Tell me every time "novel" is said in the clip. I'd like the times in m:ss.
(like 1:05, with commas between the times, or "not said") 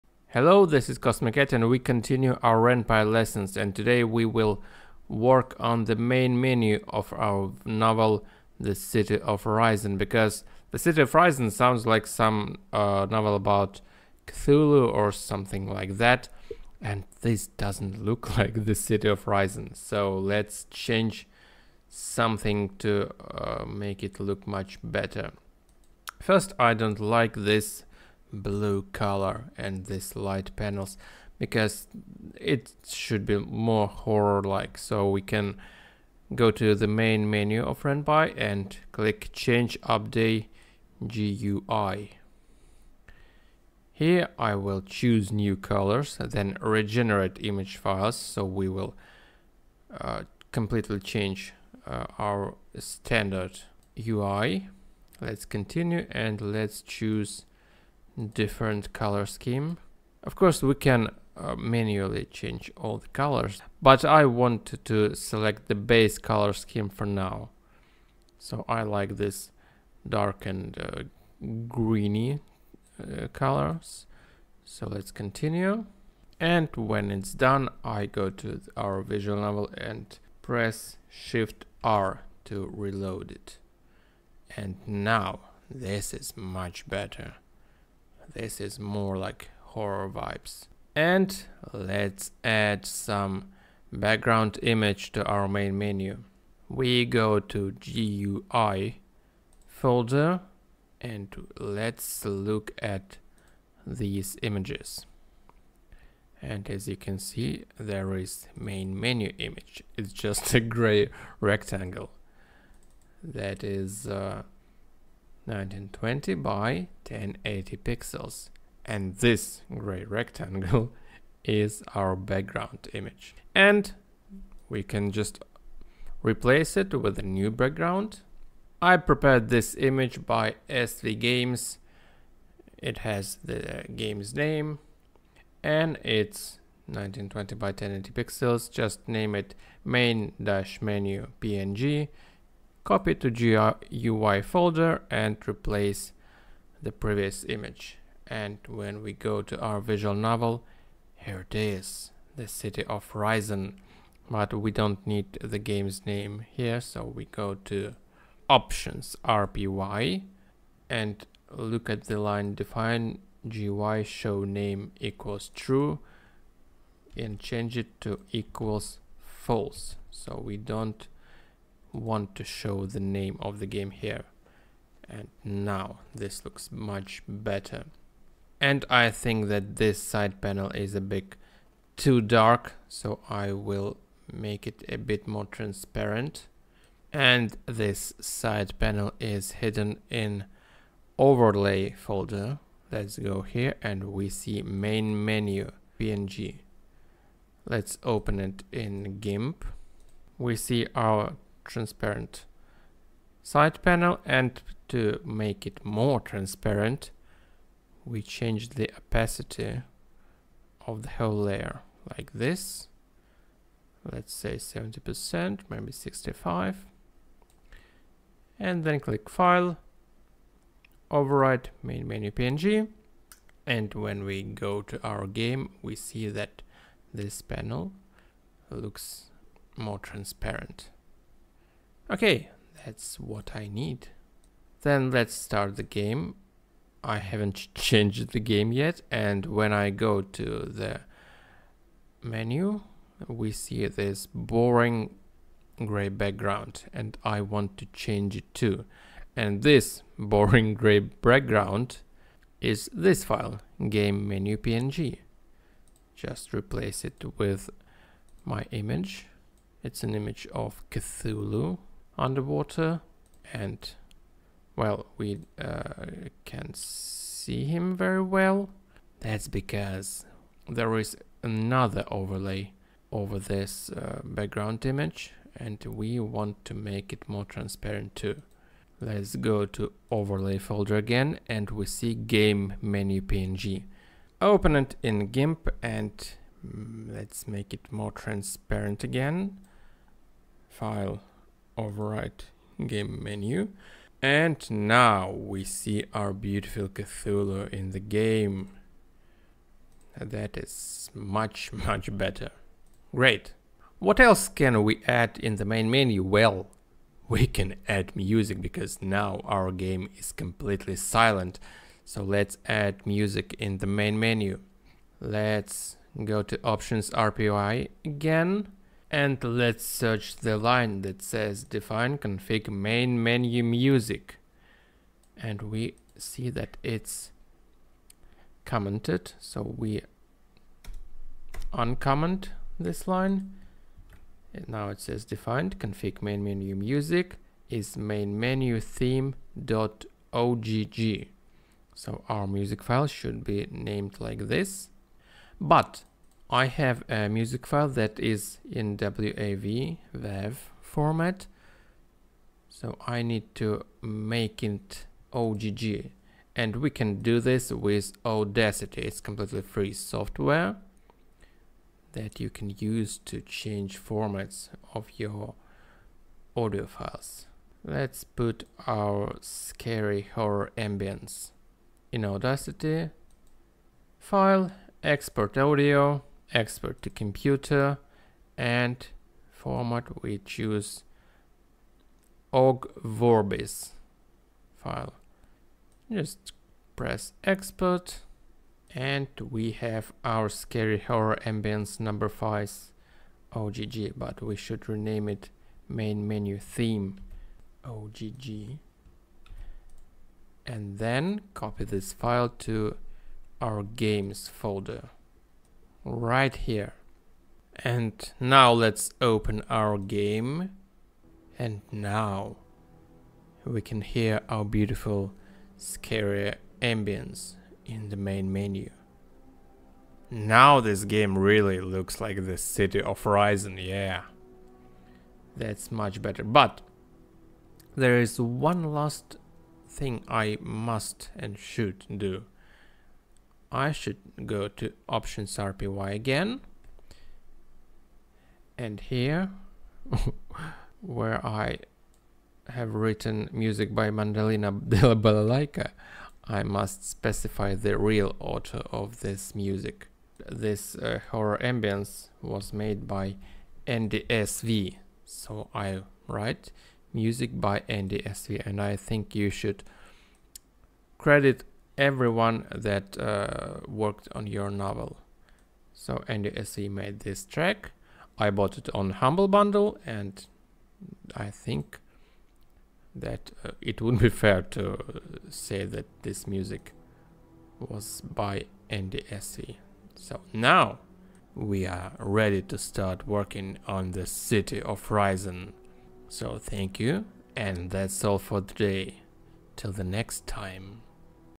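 0:07, 0:13, 1:19, 2:30, 7:44.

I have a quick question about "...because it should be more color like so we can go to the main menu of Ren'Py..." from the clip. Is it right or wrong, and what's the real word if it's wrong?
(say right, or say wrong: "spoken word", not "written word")
wrong: "horror", not "color".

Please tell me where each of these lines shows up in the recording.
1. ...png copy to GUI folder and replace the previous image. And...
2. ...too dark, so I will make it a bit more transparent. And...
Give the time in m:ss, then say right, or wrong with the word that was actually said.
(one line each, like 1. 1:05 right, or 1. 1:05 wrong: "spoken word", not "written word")
1. 2:21 right
2. 3:01 right.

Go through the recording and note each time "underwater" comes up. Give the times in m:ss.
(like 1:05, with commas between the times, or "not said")
4:22.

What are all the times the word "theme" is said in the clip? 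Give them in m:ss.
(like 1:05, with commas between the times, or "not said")
5:38, 6:36.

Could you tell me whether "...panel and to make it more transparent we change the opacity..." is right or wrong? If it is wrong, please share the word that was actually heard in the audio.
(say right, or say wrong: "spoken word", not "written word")
right.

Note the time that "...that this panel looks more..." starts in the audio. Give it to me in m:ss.
3:46.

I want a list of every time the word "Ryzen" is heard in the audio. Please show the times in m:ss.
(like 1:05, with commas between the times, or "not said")
2:33, 8:05.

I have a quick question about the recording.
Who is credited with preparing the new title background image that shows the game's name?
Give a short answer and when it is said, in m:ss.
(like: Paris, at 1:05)
SV Games, at 2:10.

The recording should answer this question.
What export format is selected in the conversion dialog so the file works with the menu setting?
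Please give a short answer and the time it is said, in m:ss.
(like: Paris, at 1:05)
Ogg Vorbis, at 6:22.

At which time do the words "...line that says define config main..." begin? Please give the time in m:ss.
5:20.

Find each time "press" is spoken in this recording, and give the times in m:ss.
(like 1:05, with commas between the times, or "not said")
1:20, 6:26.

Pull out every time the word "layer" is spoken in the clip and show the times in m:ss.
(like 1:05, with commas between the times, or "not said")
3:31.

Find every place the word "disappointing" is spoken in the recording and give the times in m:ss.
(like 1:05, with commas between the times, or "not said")
not said.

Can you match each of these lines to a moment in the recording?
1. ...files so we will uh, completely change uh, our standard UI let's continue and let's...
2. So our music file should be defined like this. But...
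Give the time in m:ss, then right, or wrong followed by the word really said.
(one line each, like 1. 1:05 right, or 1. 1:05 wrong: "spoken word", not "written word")
1. 0:47 right
2. 5:41 wrong: "named", not "defined".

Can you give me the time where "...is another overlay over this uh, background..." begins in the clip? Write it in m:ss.
4:30.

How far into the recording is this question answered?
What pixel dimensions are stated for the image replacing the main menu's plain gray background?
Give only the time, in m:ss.
1:55.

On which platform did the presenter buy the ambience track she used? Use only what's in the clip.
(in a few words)
Humble Bundle.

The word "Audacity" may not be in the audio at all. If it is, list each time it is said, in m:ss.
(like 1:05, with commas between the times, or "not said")
5:58, 6:12.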